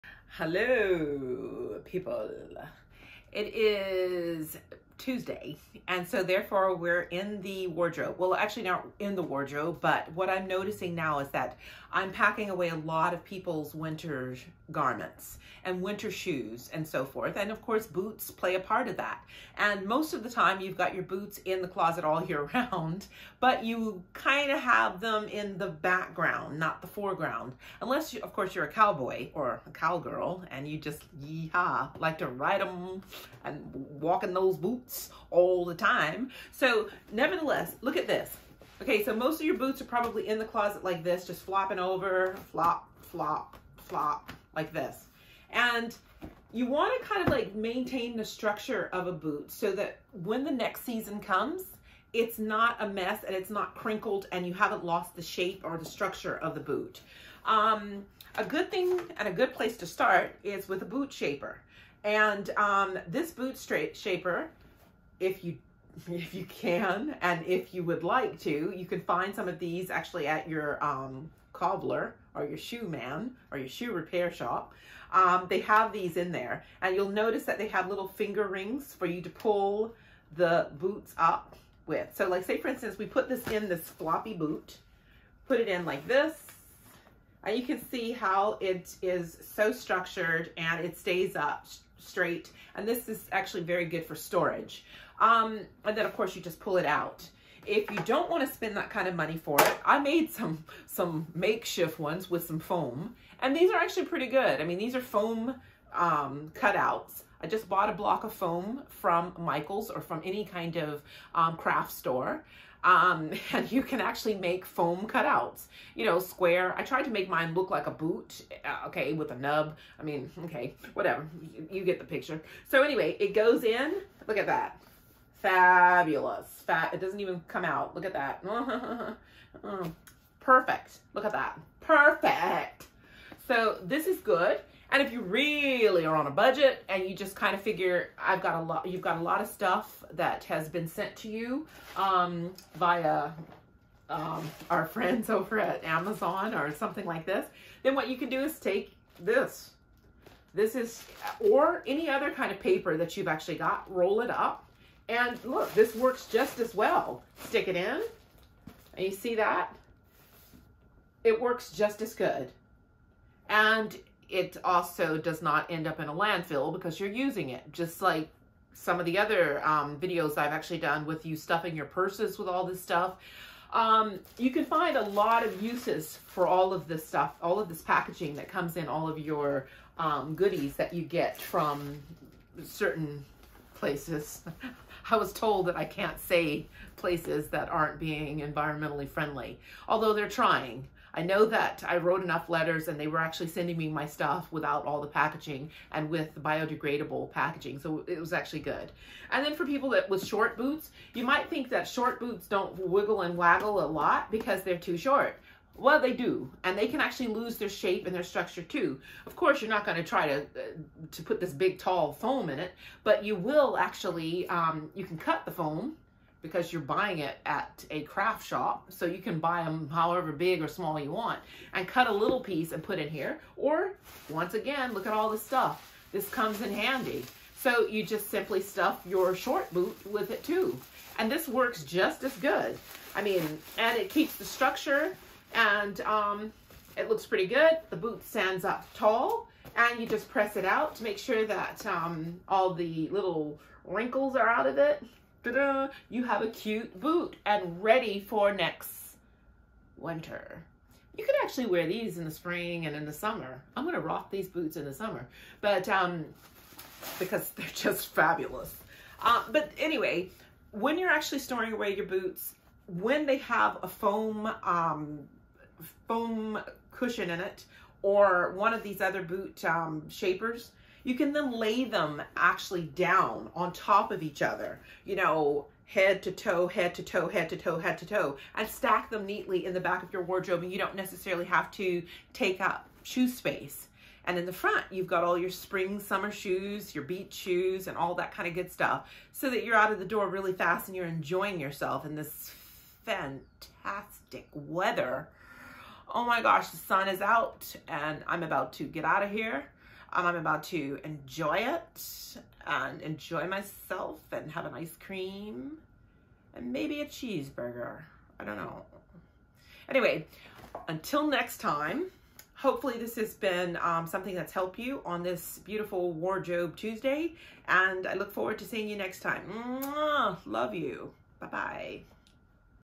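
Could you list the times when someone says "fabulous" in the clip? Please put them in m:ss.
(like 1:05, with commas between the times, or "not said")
2:05, 4:18.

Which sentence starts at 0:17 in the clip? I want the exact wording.
And of course, boots play a part of that.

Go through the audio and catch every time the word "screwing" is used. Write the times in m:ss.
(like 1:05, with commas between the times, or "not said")
not said.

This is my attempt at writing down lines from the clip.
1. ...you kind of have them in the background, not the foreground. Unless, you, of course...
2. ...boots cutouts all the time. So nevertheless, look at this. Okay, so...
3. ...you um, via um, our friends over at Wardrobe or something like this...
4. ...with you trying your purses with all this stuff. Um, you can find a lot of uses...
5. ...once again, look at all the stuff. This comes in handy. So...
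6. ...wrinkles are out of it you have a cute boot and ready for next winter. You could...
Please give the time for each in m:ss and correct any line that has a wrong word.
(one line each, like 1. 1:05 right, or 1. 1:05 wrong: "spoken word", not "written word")
1. 0:23 right
2. 0:34 wrong: "boots", not "cutouts"
3. 2:21 wrong: "Amazon", not "Wardrobe"
4. 2:51 wrong: "stuffing", not "trying"
5. 3:44 right
6. 4:03 right.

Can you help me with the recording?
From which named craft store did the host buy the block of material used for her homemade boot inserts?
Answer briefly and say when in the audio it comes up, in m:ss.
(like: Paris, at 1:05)
Michael's, at 1:49.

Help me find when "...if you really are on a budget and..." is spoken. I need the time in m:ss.
2:15.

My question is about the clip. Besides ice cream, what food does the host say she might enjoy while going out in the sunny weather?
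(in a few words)
A cheeseburger.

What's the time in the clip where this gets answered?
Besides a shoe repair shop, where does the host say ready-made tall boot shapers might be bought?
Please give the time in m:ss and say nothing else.
1:11.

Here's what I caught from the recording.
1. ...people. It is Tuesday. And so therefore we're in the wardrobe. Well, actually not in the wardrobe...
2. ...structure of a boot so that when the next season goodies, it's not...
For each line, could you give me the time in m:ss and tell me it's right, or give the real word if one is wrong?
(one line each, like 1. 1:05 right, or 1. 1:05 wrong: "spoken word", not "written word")
1. 0:01 right
2. 0:48 wrong: "comes", not "goodies".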